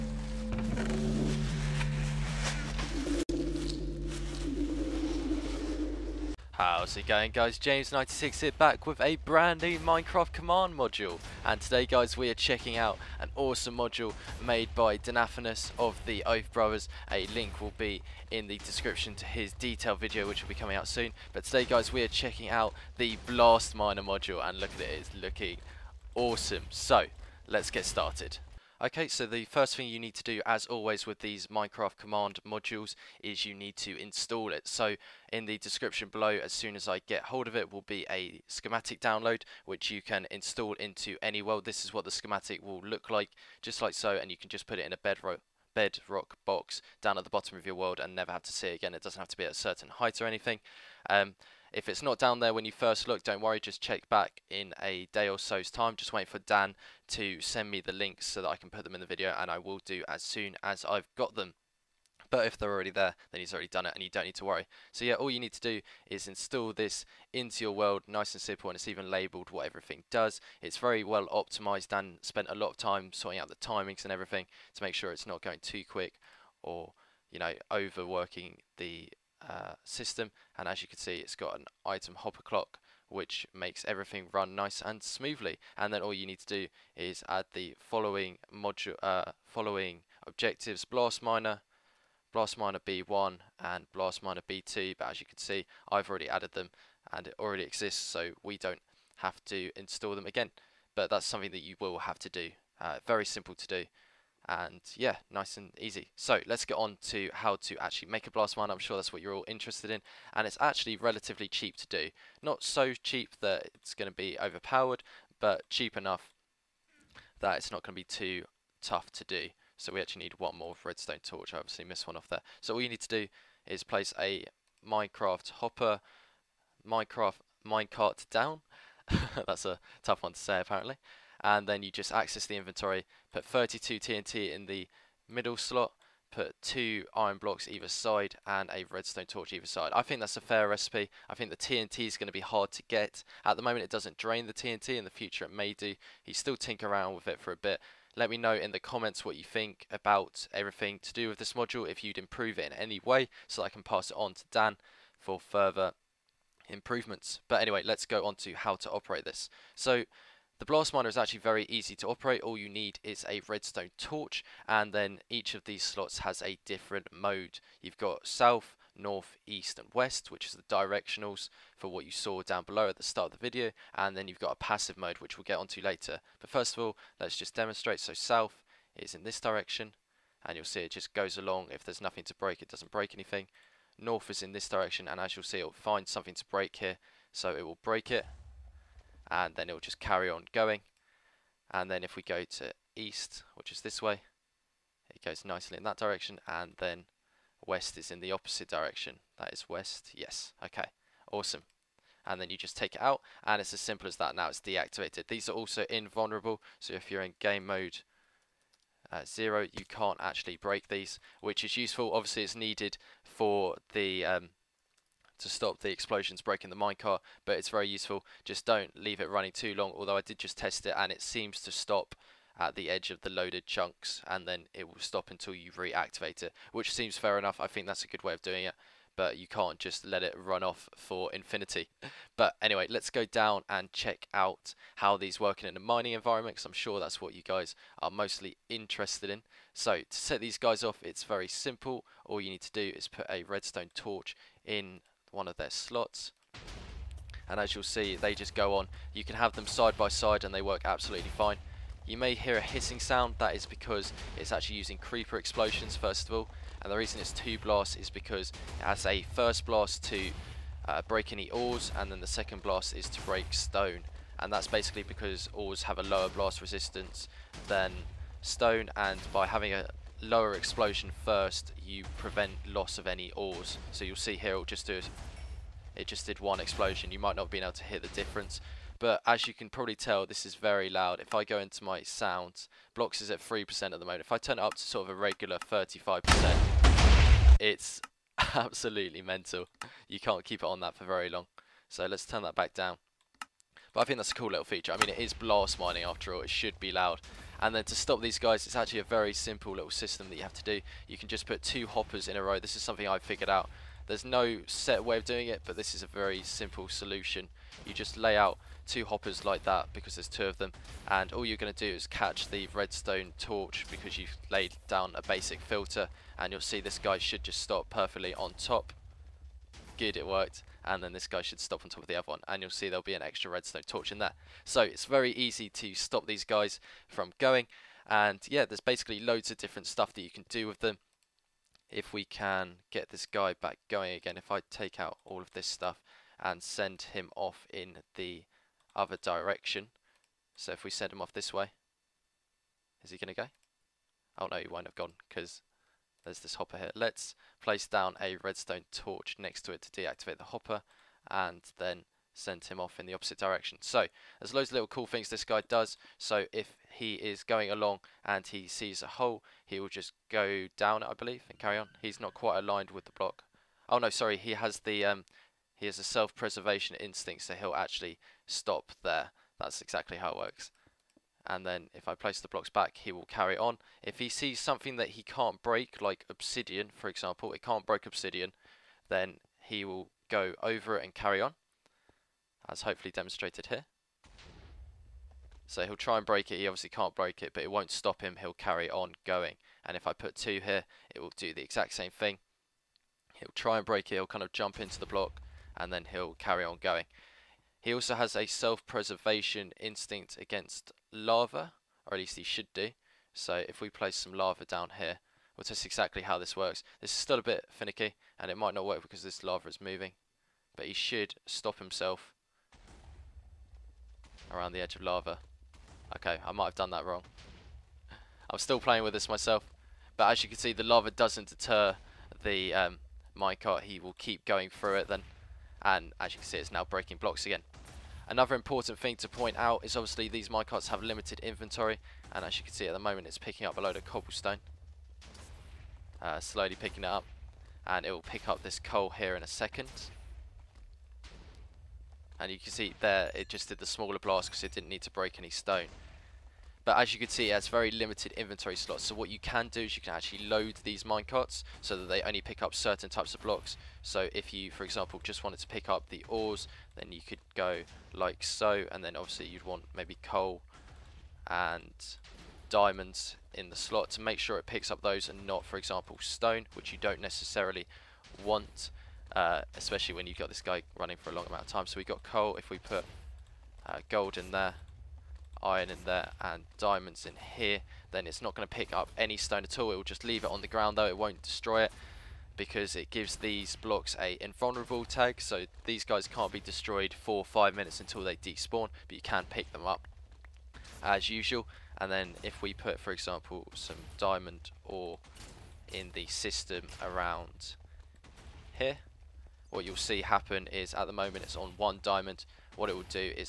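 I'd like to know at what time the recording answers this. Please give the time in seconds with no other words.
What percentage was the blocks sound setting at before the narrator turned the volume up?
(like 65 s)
283 s.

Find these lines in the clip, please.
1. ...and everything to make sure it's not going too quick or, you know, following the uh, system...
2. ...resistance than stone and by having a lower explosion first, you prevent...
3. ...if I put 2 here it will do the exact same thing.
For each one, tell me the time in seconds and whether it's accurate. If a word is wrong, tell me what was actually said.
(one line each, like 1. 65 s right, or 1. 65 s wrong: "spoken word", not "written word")
1. 74 s wrong: "overworking", not "following"
2. 266 s right
3. 389 s right.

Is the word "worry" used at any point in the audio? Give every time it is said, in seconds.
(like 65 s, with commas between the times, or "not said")
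53 s, 64 s.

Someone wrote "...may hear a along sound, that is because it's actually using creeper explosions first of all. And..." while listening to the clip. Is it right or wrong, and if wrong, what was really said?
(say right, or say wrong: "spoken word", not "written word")
wrong: "hissing", not "along".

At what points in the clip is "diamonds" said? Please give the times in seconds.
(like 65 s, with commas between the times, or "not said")
462 s, 476 s, 494 s, 502 s.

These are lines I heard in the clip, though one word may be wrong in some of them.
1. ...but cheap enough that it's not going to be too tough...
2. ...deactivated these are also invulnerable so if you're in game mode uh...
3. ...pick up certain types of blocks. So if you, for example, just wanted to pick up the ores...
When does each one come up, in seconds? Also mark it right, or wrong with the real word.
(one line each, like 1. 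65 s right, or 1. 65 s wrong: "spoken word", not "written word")
1. 115 s right
2. 204 s right
3. 452 s right.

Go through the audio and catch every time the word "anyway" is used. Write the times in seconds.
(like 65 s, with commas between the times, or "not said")
157 s, 232 s.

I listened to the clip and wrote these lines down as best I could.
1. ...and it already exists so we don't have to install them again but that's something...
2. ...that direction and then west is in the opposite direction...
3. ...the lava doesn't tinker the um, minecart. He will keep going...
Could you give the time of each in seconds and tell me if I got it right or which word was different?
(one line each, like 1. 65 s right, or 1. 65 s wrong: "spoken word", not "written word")
1. 97 s right
2. 195 s right
3. 420 s wrong: "deter", not "tinker".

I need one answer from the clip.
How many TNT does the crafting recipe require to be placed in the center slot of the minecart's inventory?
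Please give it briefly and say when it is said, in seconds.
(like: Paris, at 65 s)
32, at 133 s.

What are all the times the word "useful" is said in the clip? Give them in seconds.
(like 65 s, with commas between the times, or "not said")
211 s, 217 s.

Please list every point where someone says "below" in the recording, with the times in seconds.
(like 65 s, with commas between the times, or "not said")
36 s, 172 s.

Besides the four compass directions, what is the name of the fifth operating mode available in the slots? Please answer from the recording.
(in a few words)
passive mode.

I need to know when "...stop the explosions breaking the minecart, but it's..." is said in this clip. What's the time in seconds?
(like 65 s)
215 s.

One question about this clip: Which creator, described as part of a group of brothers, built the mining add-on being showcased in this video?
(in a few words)
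Danaphanus.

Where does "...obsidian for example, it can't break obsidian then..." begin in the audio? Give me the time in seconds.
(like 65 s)
376 s.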